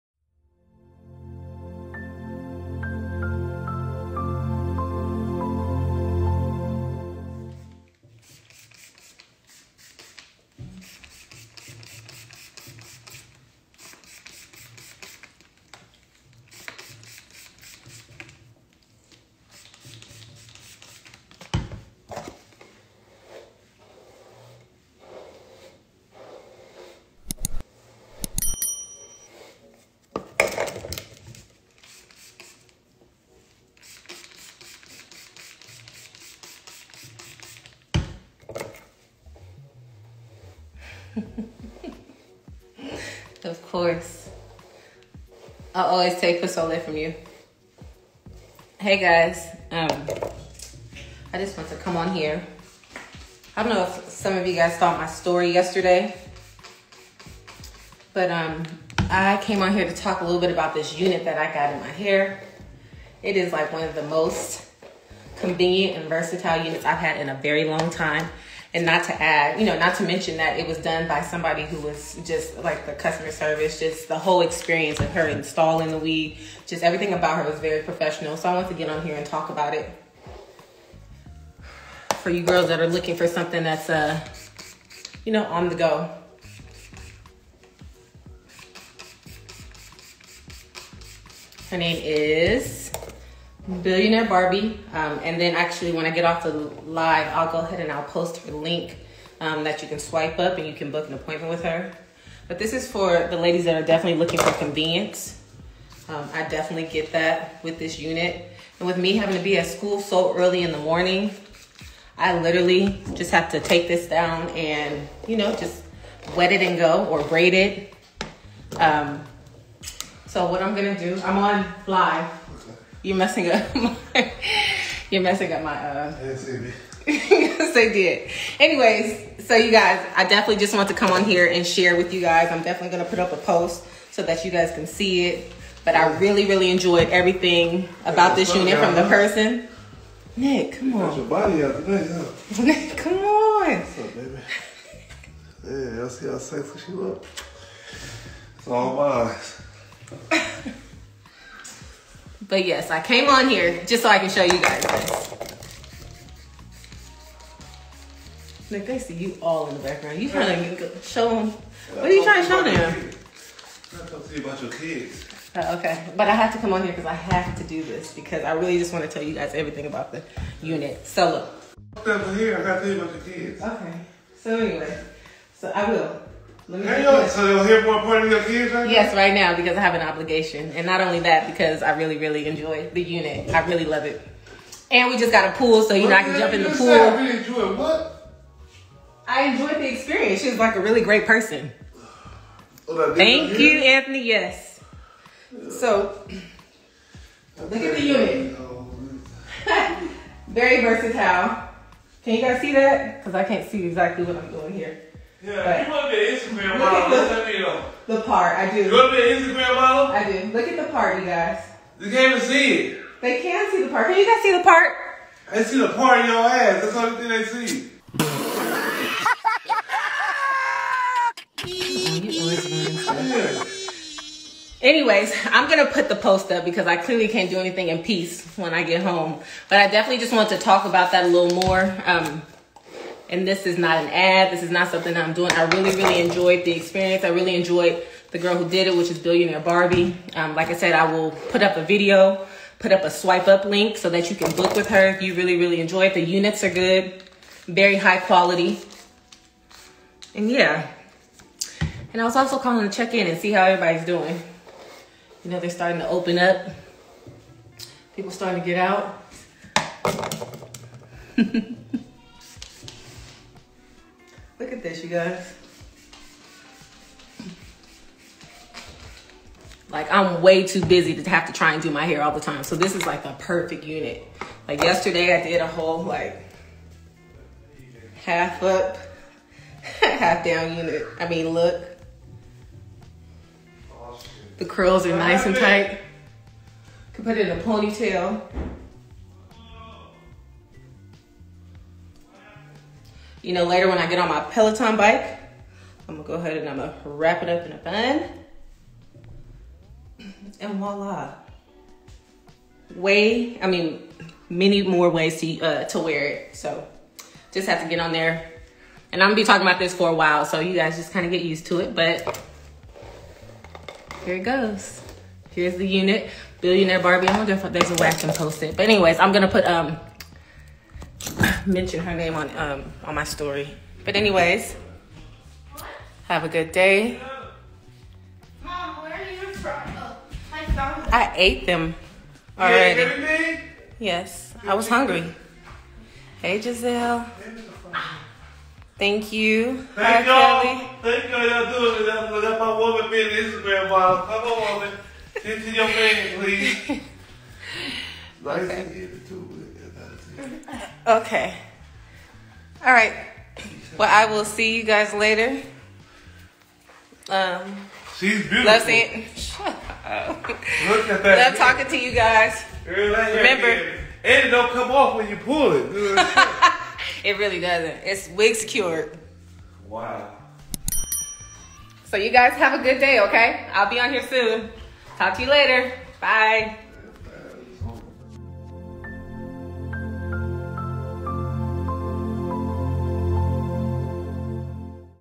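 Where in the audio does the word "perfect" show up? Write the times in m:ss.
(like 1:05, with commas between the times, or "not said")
4:33.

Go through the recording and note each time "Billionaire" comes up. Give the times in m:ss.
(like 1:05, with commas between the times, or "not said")
1:33, 3:59, 5:16.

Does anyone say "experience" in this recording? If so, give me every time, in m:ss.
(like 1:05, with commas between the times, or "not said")
1:14, 3:09, 3:56.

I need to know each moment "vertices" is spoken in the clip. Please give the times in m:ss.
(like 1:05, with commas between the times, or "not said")
not said.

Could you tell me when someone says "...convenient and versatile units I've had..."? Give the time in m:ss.
1:05.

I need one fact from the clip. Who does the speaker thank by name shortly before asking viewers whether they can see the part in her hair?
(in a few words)
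Anthony.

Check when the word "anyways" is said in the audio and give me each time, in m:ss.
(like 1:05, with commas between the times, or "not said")
2:08, 2:54, 3:44, 5:18, 5:24.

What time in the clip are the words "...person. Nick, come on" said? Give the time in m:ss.
2:19.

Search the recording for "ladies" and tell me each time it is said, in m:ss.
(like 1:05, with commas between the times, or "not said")
1:43.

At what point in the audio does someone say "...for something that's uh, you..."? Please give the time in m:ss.
1:23.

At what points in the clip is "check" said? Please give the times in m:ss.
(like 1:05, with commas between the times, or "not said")
4:12.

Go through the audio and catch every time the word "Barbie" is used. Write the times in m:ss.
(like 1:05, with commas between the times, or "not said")
1:34, 3:59, 5:16.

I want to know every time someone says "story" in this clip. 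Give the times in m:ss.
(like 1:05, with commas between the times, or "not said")
0:55, 5:23.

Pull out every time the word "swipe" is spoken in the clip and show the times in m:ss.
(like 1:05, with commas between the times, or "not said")
1:39, 4:03.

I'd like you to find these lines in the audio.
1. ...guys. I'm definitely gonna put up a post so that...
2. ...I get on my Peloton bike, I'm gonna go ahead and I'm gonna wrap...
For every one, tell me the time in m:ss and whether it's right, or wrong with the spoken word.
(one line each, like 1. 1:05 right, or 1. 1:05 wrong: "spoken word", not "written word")
1. 2:12 right
2. 4:53 right.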